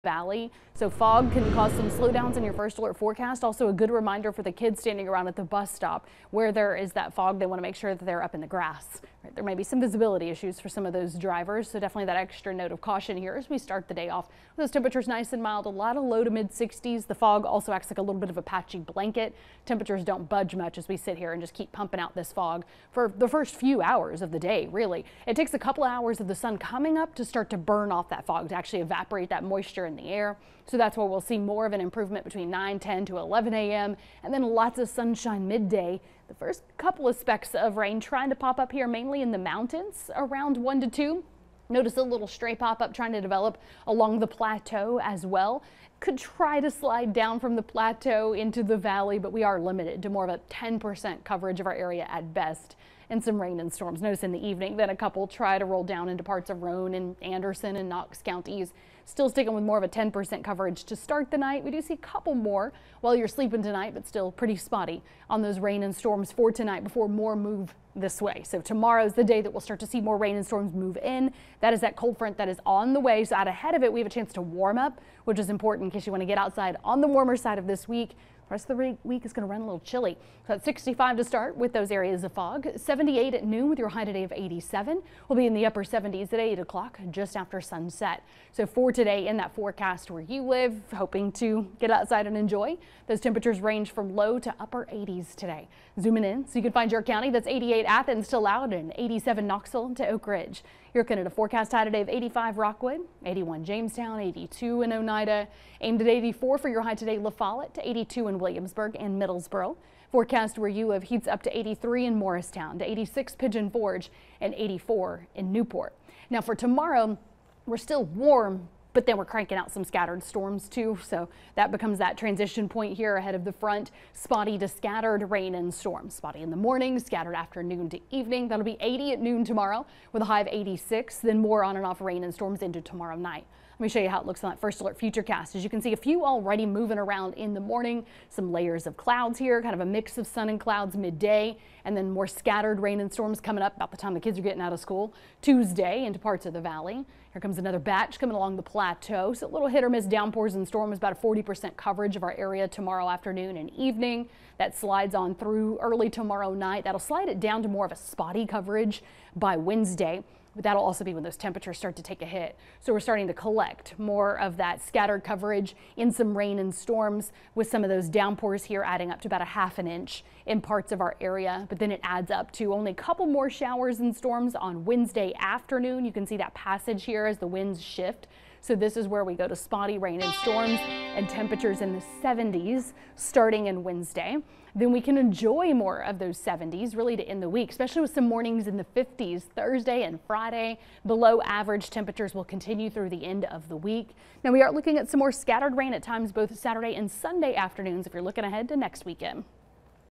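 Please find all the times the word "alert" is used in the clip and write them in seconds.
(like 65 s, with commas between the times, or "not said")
2 s, 134 s.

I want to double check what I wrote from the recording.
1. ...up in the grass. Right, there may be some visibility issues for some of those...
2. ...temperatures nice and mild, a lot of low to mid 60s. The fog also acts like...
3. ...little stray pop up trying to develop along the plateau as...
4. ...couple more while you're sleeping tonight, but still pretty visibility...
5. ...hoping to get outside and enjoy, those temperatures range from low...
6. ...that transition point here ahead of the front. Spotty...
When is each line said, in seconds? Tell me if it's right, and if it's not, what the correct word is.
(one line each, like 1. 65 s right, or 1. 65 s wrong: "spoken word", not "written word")
1. 8 s right
2. 14 s right
3. 42 s right
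4. 61 s wrong: "spotty", not "visibility"
5. 90 s right
6. 121 s right.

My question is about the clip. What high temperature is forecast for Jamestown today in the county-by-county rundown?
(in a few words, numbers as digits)
81.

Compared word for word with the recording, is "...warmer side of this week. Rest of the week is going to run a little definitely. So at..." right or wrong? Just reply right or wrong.
wrong.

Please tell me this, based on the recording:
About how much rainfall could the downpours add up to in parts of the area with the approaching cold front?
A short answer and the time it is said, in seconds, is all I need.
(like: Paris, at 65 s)
half an inch, at 169 s.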